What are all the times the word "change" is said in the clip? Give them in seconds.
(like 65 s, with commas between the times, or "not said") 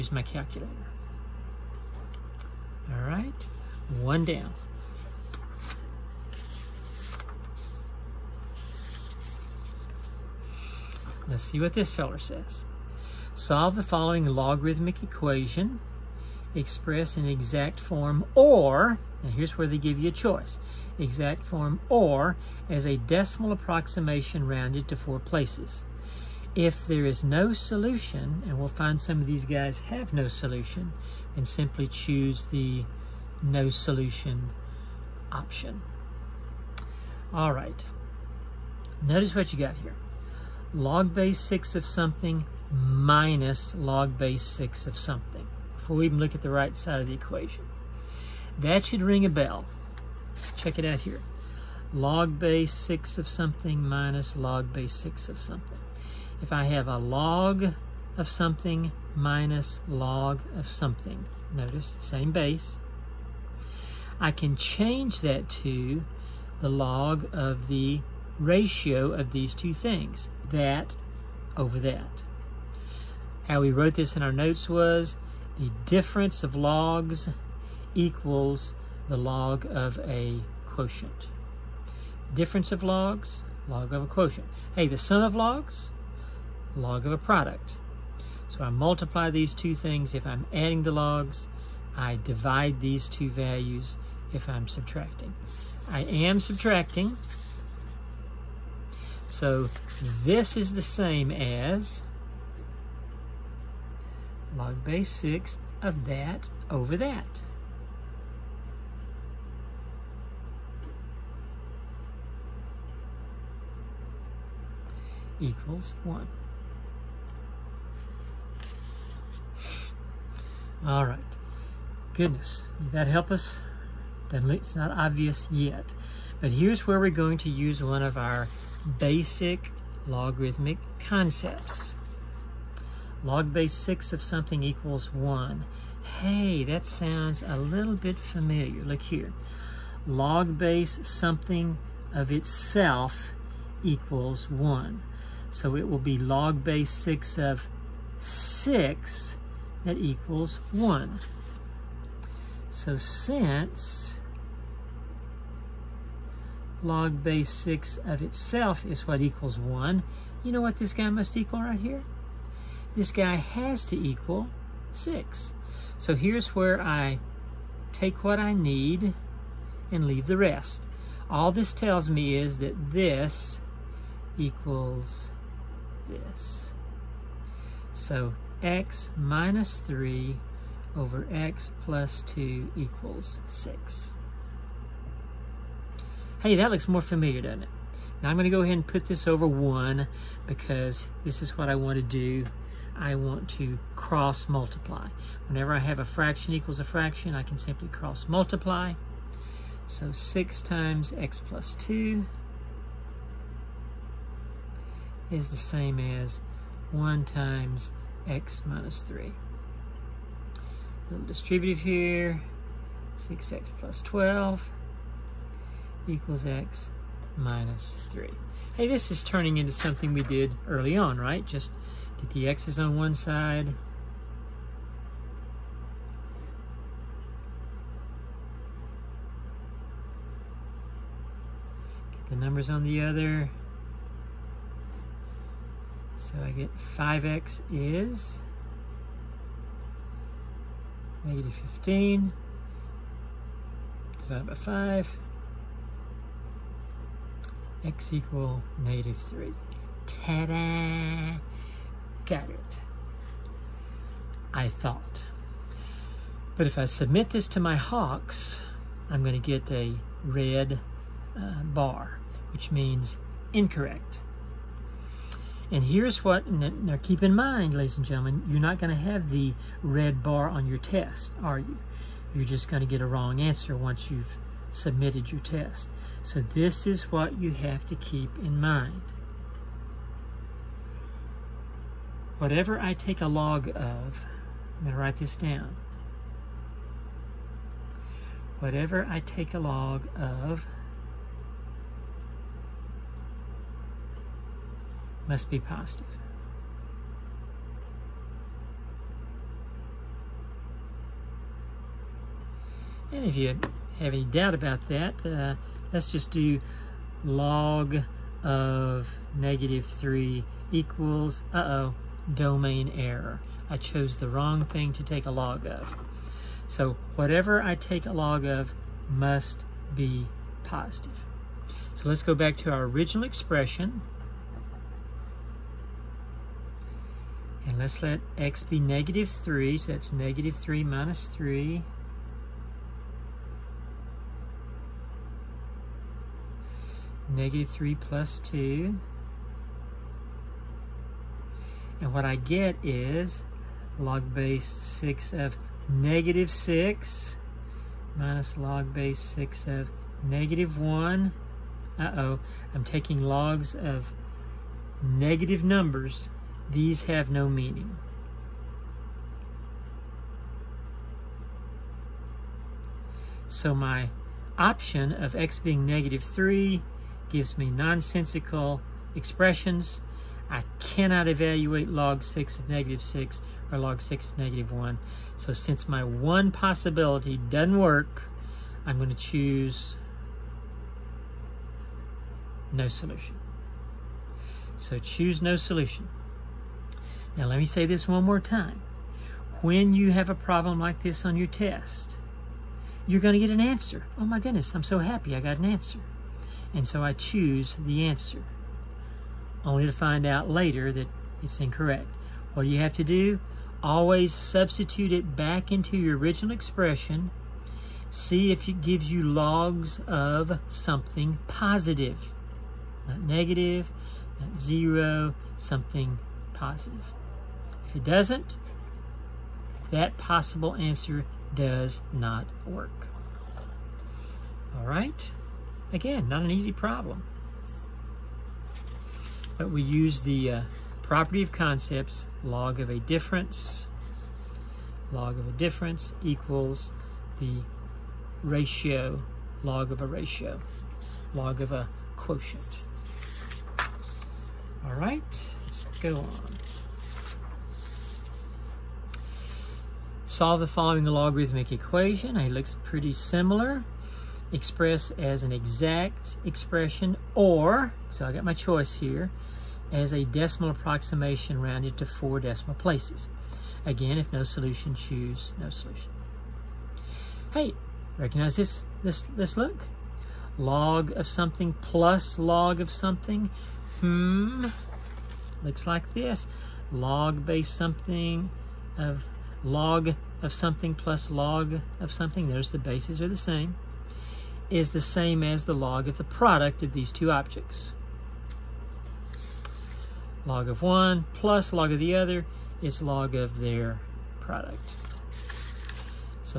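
64 s.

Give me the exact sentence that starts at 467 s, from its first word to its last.
Hey, recognize this, this, this look?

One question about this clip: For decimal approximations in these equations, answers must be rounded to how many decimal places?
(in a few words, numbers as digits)
4.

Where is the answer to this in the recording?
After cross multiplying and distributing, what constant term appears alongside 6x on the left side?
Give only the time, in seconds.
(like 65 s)
213 s.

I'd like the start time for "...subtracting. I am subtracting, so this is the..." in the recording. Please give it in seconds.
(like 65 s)
94 s.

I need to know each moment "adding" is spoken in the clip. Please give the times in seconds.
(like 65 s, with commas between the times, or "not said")
90 s.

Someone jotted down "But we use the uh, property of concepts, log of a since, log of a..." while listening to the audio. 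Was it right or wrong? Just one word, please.
wrong.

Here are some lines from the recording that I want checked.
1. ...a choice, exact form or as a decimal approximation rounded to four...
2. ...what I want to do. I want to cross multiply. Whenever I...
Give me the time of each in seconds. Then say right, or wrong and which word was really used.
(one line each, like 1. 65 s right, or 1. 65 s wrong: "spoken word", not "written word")
1. 20 s right
2. 191 s right.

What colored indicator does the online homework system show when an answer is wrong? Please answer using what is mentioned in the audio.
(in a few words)
red bar.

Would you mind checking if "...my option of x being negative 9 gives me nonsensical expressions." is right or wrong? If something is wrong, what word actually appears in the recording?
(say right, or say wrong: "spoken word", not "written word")
wrong: "3", not "9".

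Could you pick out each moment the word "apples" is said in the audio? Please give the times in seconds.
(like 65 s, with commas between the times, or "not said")
not said.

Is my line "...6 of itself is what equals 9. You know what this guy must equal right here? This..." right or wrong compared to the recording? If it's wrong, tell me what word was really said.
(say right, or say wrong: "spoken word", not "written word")
wrong: "1", not "9".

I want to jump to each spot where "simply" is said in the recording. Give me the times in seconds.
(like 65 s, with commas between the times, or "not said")
31 s, 197 s.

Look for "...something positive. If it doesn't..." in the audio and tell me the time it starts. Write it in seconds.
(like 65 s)
415 s.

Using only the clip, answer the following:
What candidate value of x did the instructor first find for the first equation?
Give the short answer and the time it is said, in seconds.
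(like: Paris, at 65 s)
-3, at 247 s.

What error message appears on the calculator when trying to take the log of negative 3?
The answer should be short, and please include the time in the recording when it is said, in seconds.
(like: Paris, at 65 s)
domain error, at 312 s.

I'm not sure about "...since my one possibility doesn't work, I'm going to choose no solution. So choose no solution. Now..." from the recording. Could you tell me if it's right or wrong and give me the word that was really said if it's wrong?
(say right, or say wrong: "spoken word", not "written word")
right.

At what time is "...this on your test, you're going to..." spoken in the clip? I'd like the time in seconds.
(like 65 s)
391 s.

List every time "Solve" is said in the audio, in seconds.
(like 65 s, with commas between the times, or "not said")
13 s, 450 s.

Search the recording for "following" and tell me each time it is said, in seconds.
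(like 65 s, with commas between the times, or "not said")
13 s, 450 s.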